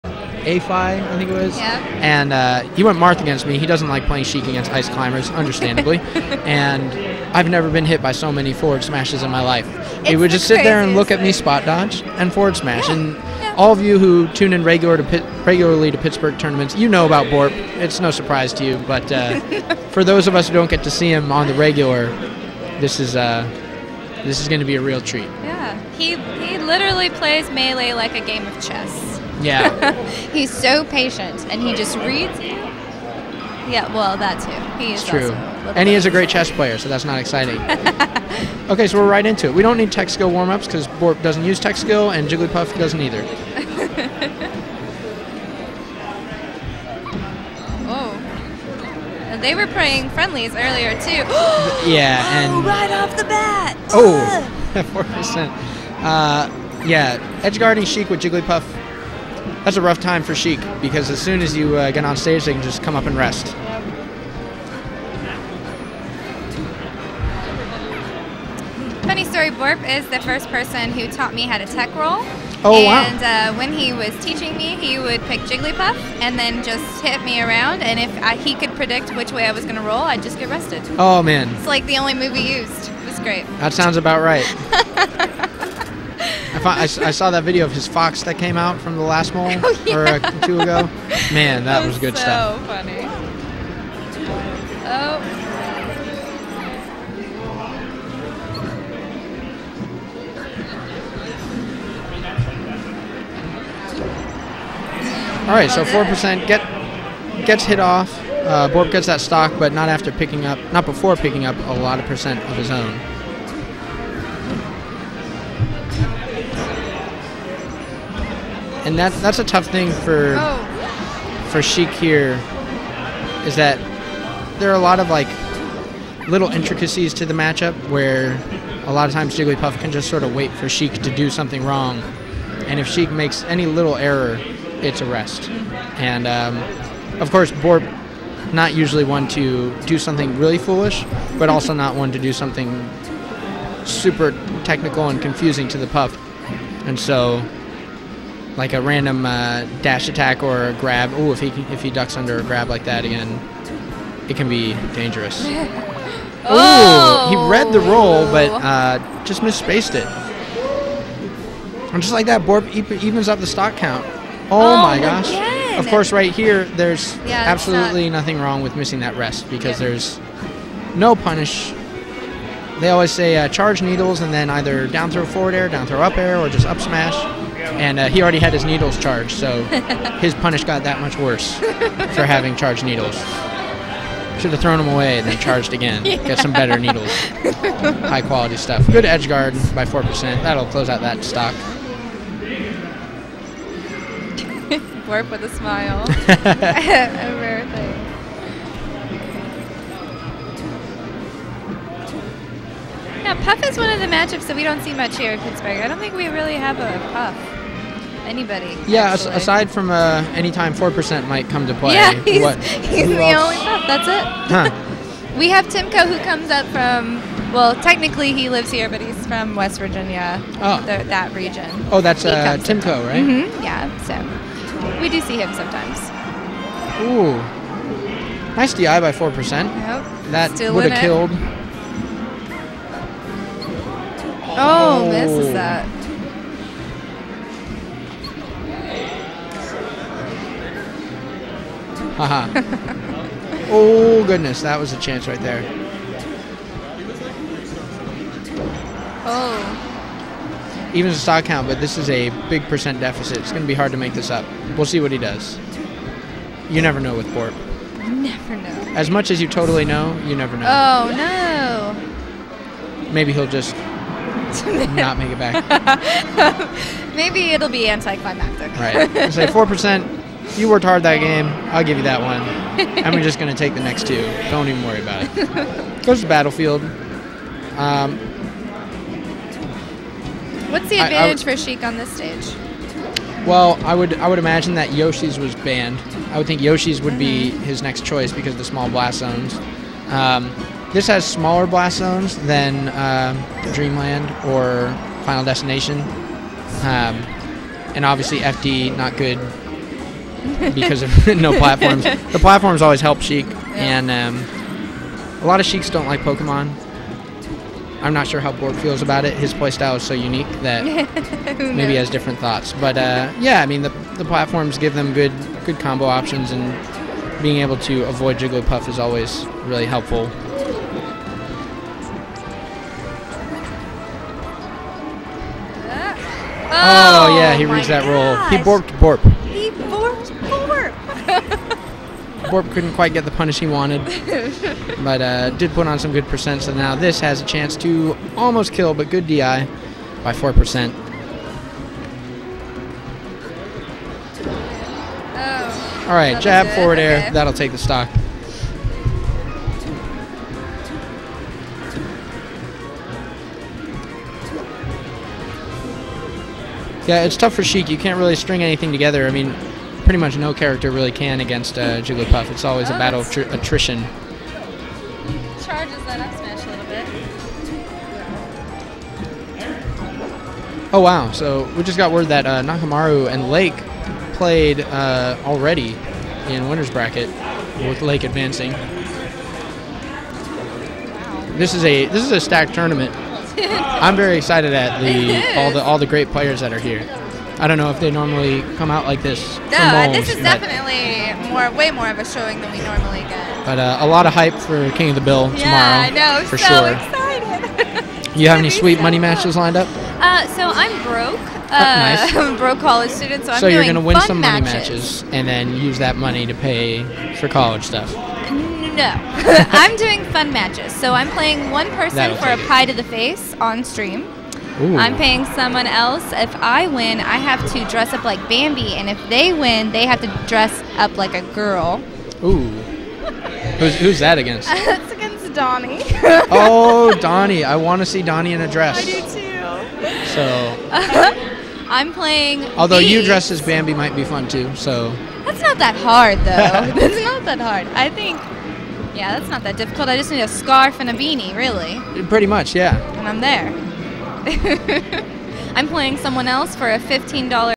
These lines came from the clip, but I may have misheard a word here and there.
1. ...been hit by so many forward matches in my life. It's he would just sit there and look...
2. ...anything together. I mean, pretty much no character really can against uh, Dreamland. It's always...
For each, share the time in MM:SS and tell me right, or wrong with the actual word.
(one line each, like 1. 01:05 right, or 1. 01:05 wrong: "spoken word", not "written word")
1. 00:07 wrong: "smashes", not "matches"
2. 05:58 wrong: "Jigglypuff", not "Dreamland".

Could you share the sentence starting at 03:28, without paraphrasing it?
Yeah, aside from uh, anytime 4% might come to play.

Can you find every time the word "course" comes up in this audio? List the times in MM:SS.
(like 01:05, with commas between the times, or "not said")
02:17, 02:45.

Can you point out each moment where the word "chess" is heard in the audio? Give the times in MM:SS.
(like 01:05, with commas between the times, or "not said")
00:28, 00:36.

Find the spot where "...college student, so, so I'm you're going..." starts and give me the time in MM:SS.
06:42.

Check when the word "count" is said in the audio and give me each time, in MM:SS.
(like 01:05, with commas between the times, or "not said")
02:43, 04:11.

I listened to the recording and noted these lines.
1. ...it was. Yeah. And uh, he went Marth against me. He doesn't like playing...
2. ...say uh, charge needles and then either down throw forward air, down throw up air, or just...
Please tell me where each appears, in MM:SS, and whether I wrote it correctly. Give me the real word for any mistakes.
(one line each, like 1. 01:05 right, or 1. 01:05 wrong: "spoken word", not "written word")
1. 00:01 right
2. 02:53 right.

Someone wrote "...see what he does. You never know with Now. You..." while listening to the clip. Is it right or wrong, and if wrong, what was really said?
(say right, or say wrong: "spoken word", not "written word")
wrong: "Borp", not "Now".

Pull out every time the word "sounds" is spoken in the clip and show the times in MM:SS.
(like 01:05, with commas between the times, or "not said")
01:23.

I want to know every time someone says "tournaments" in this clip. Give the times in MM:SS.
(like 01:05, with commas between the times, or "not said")
00:16, 06:22.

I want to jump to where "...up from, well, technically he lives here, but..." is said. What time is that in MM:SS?
03:36.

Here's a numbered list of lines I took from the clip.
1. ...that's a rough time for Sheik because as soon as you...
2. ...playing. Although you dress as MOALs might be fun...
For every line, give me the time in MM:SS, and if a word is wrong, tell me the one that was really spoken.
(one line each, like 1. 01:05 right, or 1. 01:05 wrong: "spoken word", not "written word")
1. 00:59 right
2. 07:12 wrong: "Bambi", not "MOALs".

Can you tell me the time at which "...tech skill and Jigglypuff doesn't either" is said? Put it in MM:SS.
00:41.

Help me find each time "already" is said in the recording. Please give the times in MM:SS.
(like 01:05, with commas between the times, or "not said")
02:58, 06:15.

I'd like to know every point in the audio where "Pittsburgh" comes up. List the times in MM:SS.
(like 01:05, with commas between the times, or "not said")
00:15, 03:25.